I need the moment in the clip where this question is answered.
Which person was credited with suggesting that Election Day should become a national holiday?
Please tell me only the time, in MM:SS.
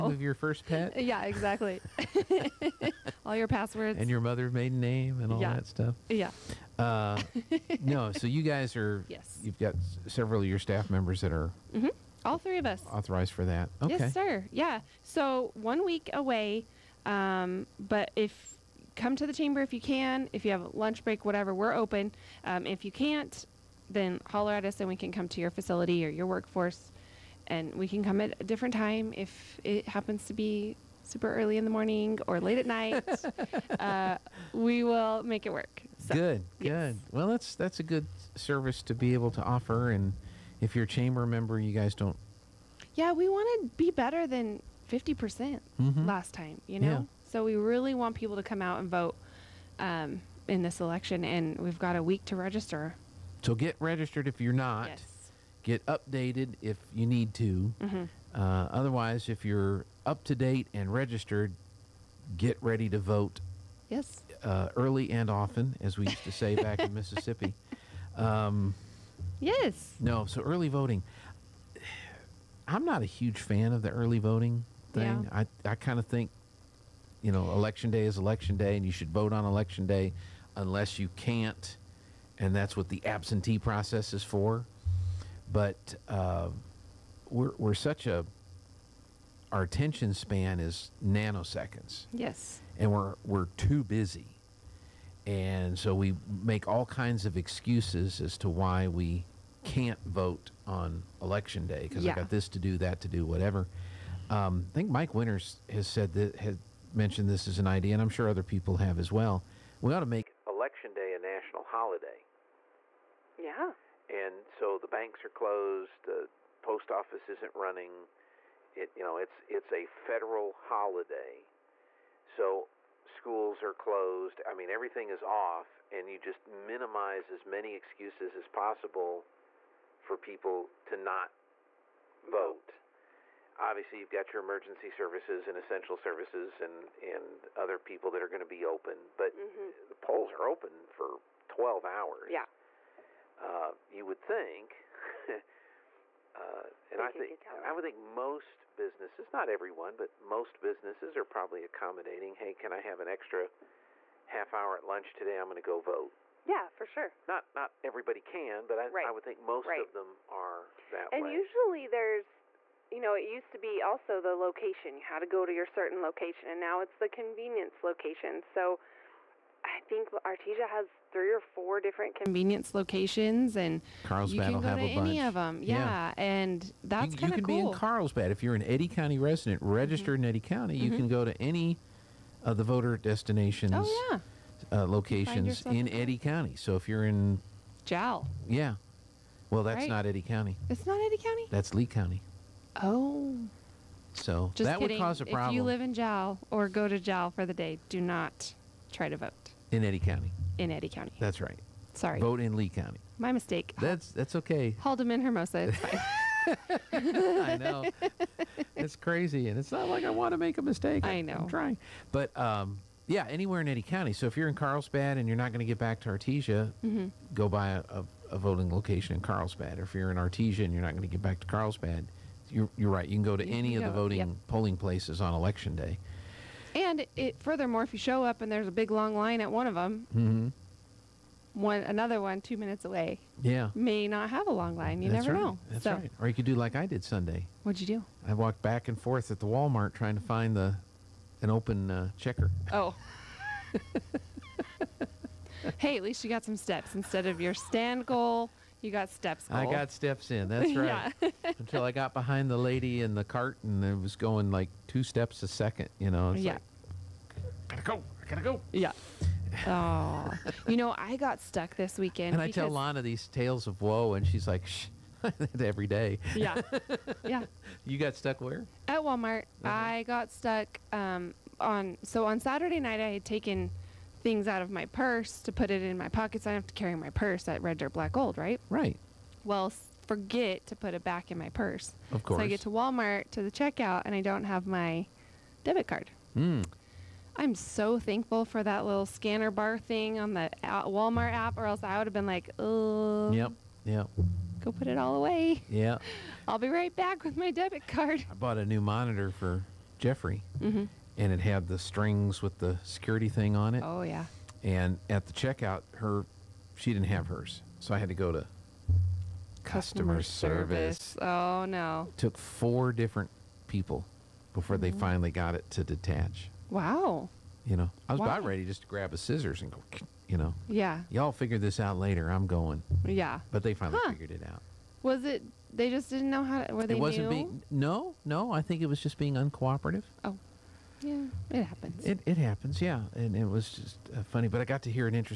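01:44.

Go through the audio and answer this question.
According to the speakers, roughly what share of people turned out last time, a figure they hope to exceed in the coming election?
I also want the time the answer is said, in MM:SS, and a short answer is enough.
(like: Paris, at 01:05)
50%, at 00:44.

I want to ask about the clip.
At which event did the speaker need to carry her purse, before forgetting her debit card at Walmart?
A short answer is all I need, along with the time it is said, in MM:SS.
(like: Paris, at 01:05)
Red Dirt Black Gold, at 04:37.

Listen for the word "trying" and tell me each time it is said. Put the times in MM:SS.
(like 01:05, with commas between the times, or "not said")
03:31, 03:59.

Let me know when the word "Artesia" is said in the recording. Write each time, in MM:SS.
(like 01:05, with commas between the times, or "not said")
02:50, 03:36, 03:40.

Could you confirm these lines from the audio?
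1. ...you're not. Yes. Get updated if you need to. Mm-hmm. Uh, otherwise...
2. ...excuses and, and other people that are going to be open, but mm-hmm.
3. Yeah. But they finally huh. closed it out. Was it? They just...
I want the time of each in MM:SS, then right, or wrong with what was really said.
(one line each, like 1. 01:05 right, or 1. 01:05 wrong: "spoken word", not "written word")
1. 00:54 right
2. 02:15 wrong: "services", not "excuses"
3. 05:23 wrong: "figured", not "closed".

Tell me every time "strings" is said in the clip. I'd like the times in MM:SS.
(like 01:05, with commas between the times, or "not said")
05:01.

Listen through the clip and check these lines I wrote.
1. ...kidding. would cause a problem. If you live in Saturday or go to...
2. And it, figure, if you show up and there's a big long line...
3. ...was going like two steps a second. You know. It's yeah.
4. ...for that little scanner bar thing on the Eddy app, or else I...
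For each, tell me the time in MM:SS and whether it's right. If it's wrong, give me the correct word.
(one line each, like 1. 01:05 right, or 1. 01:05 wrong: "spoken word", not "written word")
1. 03:14 wrong: "Jal", not "Saturday"
2. 03:46 wrong: "furthermore", not "figure"
3. 04:13 right
4. 04:48 wrong: "Walmart", not "Eddy".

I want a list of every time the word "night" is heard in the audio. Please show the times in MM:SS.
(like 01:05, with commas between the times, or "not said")
00:32, 04:32.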